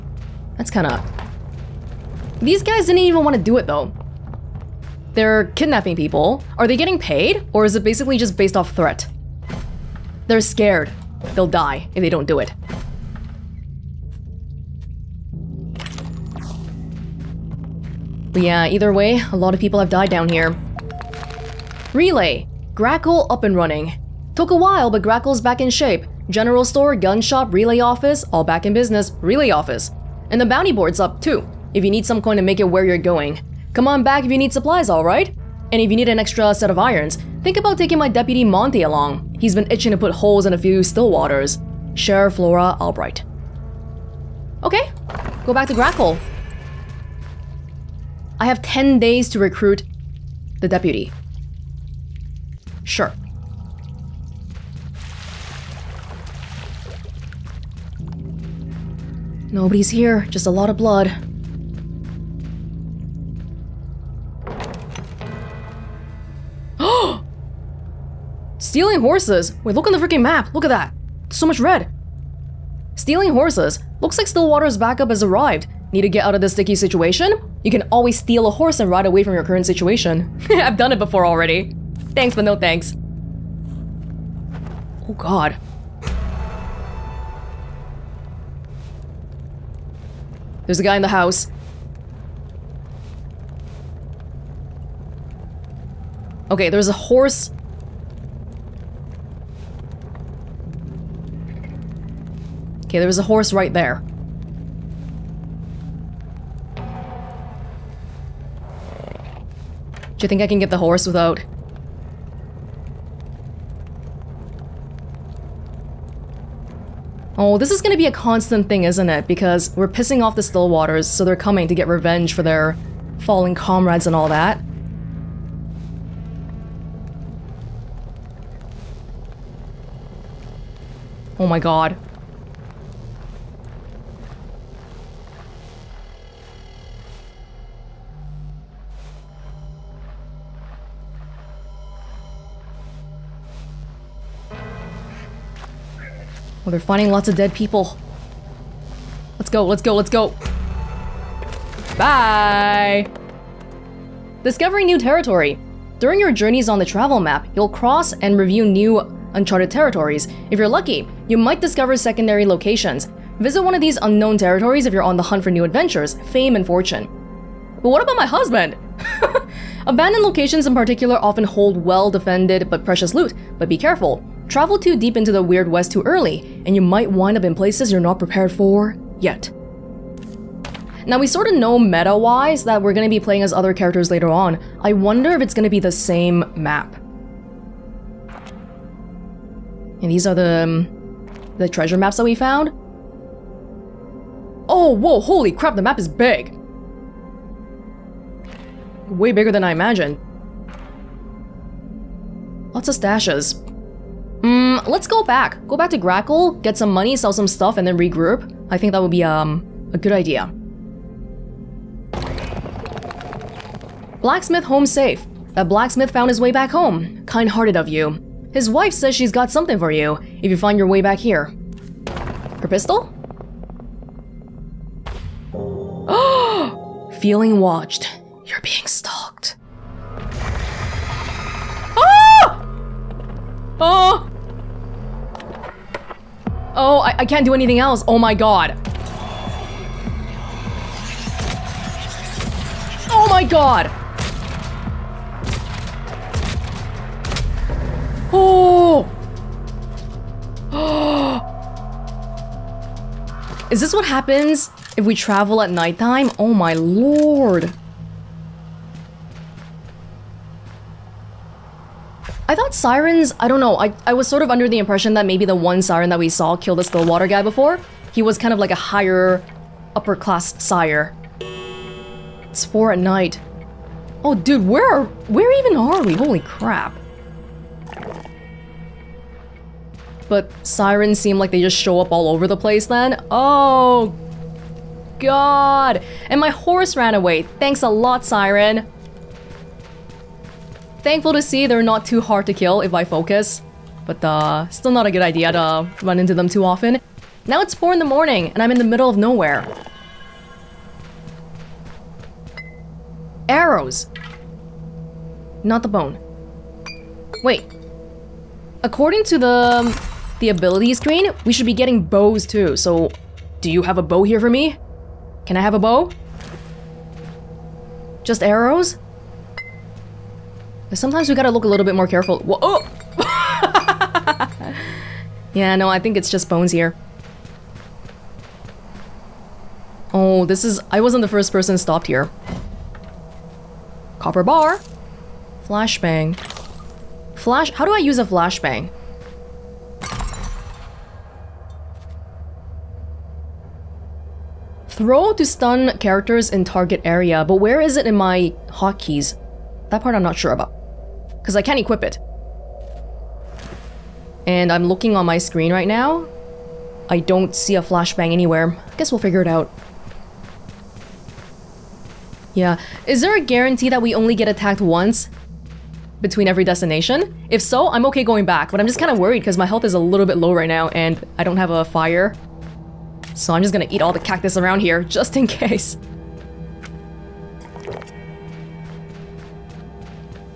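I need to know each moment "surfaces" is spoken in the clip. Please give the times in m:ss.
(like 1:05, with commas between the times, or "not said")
not said.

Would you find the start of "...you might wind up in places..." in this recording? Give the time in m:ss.
2:56.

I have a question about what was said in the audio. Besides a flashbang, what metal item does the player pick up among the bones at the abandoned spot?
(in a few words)
Copper bar.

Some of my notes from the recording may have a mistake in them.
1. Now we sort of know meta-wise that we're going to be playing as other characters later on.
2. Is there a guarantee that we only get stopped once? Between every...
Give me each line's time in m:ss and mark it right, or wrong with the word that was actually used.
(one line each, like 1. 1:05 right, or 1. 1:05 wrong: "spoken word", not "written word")
1. 3:01 right
2. 6:03 wrong: "attacked", not "stopped".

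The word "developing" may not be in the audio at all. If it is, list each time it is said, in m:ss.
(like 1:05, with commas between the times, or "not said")
not said.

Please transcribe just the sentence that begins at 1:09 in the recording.
Wait, look on the freaking map!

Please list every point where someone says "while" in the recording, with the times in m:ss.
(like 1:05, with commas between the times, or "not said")
0:24.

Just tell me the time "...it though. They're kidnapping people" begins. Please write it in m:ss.
0:03.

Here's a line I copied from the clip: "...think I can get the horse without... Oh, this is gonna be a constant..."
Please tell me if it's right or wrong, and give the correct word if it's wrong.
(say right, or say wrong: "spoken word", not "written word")
right.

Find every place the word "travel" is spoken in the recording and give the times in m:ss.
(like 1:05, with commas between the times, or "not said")
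2:36, 2:54, 4:15.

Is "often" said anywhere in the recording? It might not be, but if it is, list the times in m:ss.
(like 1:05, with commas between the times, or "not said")
2:51, 4:56.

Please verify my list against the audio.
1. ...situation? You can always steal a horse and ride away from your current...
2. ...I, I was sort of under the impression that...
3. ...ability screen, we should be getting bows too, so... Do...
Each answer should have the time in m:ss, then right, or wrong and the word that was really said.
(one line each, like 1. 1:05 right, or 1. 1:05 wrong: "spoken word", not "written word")
1. 1:16 right
2. 4:23 right
3. 5:10 right.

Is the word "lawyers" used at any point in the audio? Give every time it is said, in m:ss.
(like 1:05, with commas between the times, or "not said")
not said.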